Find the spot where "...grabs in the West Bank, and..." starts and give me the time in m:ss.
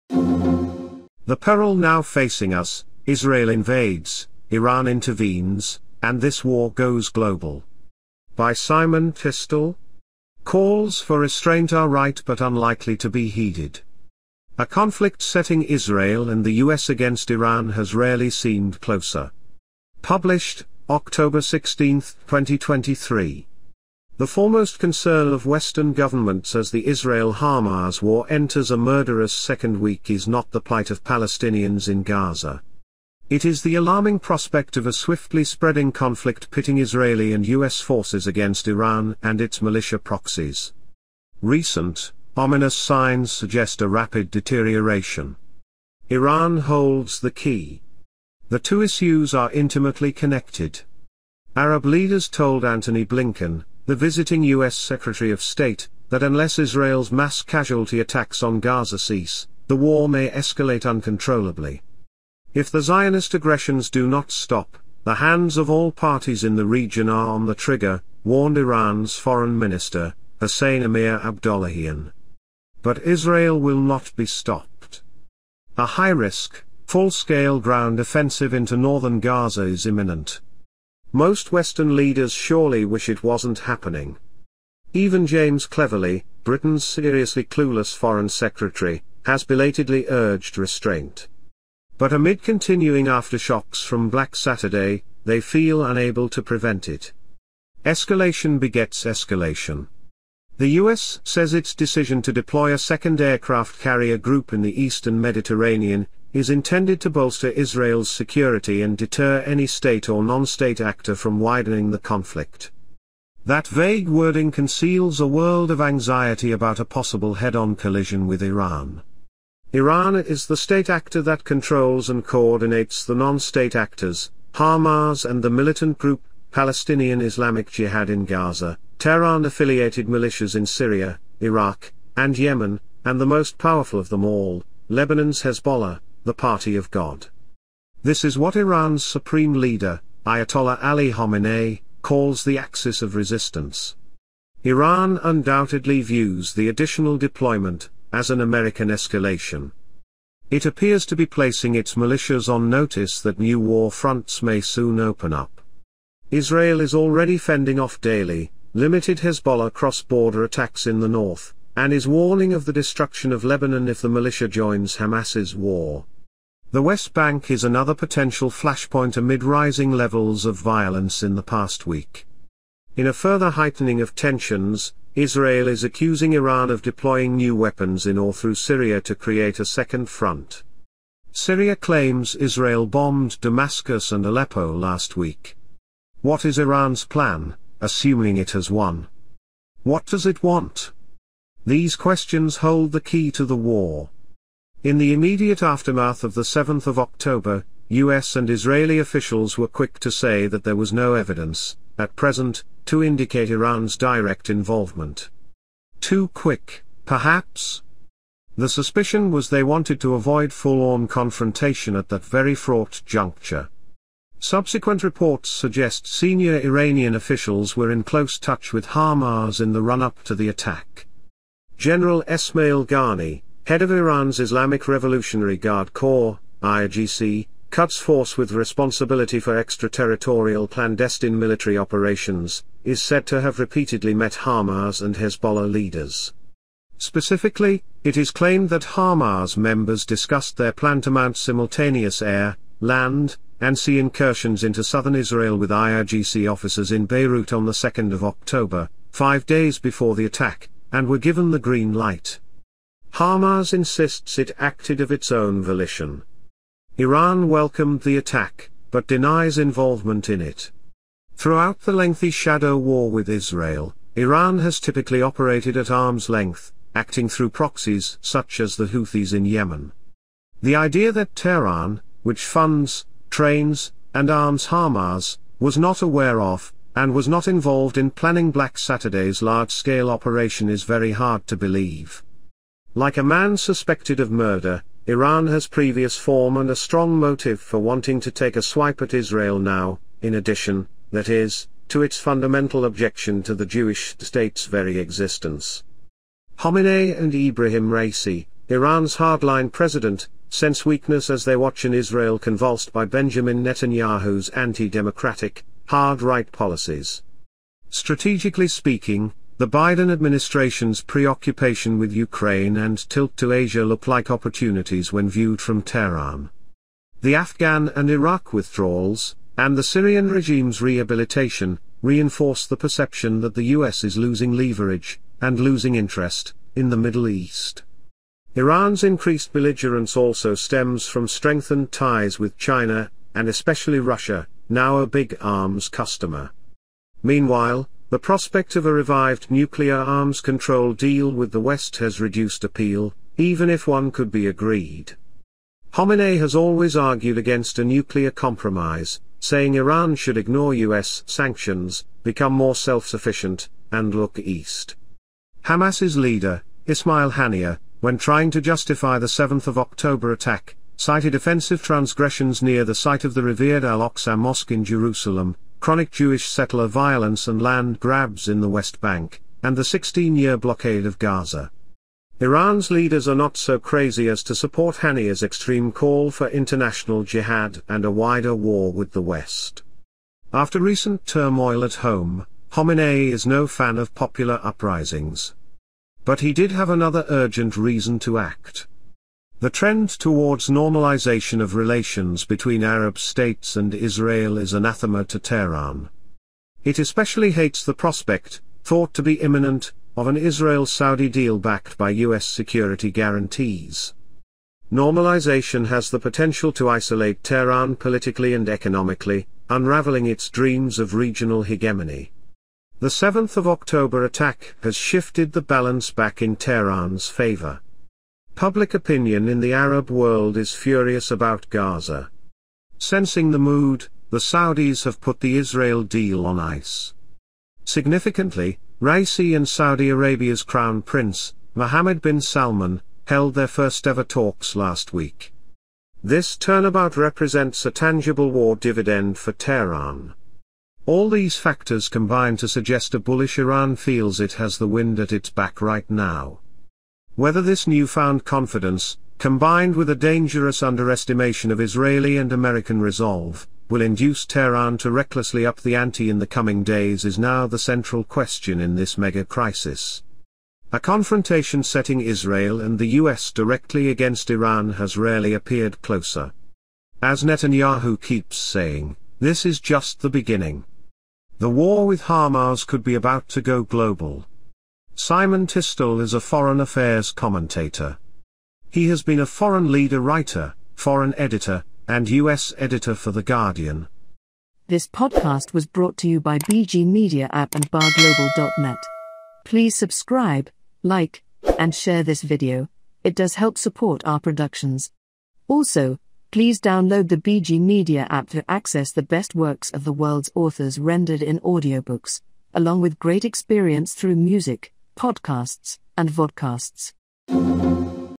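6:07.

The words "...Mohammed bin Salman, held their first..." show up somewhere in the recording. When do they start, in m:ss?
7:11.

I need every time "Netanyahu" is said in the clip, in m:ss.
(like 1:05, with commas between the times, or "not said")
5:03, 7:47.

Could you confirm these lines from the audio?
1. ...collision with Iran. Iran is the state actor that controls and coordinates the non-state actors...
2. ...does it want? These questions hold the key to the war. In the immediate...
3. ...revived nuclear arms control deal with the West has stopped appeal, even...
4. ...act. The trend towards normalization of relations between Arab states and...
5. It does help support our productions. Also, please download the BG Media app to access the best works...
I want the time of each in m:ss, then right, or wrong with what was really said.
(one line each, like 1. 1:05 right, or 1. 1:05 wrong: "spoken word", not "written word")
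1. 1:57 right
2. 3:10 right
3. 5:38 wrong: "reduced", not "stopped"
4. 6:28 right
5. 8:13 right.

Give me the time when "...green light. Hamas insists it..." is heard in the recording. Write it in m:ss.
4:11.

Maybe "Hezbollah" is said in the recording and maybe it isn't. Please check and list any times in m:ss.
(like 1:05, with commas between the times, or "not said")
2:15, 2:39, 3:55.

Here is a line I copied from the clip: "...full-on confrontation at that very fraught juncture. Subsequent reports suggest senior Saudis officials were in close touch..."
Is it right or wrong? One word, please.
wrong.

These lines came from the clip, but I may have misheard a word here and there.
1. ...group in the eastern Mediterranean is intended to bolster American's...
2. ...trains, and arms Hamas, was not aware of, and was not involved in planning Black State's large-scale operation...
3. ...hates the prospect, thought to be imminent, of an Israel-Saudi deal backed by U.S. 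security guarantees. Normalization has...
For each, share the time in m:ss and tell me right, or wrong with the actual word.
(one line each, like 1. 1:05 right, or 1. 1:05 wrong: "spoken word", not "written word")
1. 1:44 wrong: "Israel", not "American"
2. 4:33 wrong: "Saturday", not "State"
3. 6:37 right.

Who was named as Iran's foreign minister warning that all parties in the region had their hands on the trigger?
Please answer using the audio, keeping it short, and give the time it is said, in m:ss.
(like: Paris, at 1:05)
Hassan Amir Abdollahian, at 1:10.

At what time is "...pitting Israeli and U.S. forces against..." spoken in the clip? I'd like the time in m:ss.
0:36.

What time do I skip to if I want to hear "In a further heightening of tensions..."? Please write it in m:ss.
2:52.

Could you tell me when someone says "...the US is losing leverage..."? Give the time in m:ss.
5:23.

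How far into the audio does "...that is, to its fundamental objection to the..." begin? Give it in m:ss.
4:51.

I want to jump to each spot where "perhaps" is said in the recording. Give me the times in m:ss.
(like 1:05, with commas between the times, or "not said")
3:27.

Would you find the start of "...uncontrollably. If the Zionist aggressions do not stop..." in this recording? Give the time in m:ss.
1:00.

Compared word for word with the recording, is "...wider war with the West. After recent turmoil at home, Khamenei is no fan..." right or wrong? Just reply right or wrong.
right.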